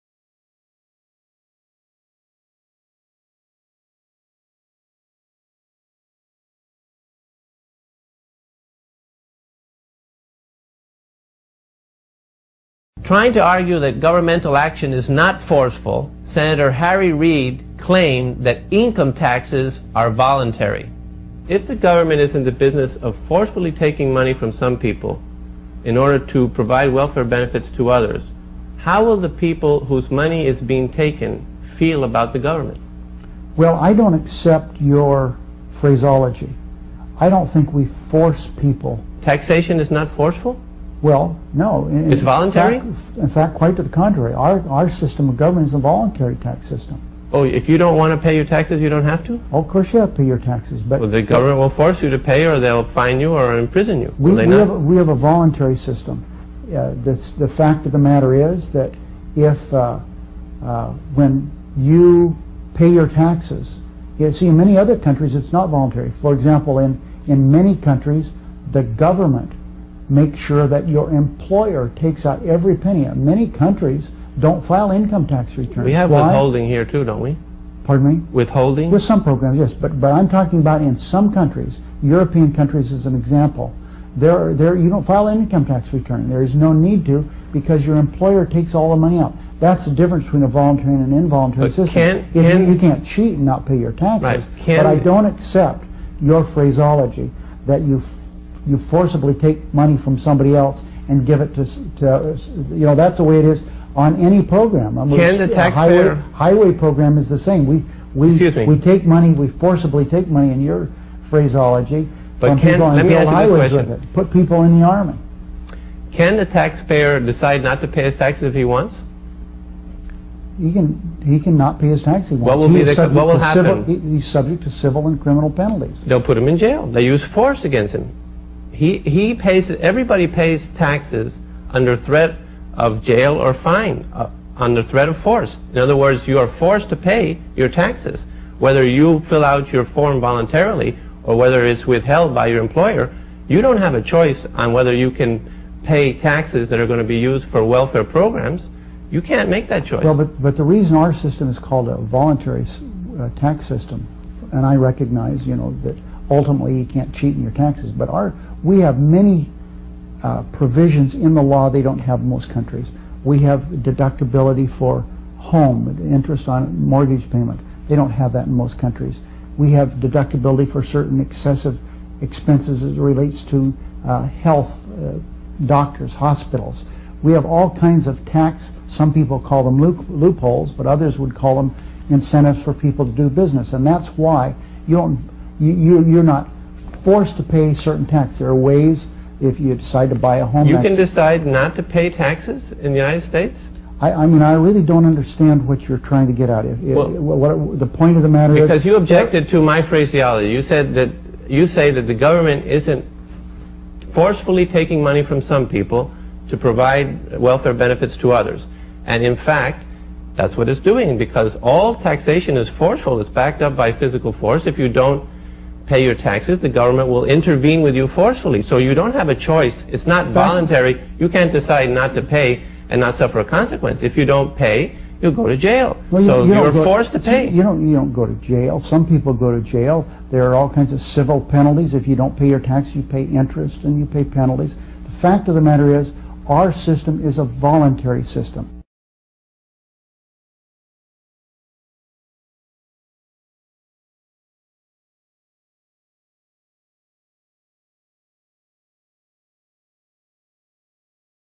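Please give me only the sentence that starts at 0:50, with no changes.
But well, the government will force you to pay or they'll fine you or imprison you.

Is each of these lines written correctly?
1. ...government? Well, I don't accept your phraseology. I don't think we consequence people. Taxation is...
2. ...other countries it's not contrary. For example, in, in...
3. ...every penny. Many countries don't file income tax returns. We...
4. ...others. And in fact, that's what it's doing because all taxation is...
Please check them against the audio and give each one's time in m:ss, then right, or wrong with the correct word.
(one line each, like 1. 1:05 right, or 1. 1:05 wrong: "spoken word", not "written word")
1. 0:32 wrong: "force", not "consequence"
2. 1:04 wrong: "voluntary", not "contrary"
3. 1:12 right
4. 3:28 right.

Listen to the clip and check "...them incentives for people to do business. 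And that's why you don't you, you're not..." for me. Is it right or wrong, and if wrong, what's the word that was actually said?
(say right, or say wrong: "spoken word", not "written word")
right.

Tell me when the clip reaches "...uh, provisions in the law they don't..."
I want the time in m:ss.
2:40.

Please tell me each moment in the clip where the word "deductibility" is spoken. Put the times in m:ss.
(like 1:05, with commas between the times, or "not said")
2:43, 2:49.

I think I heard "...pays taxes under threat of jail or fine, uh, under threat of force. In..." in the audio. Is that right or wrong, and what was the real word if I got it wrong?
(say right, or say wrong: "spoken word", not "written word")
right.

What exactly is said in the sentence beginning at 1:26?
There is no need to because your employer takes all the money out.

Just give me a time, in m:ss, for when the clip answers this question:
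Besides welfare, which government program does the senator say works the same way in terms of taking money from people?
1:46.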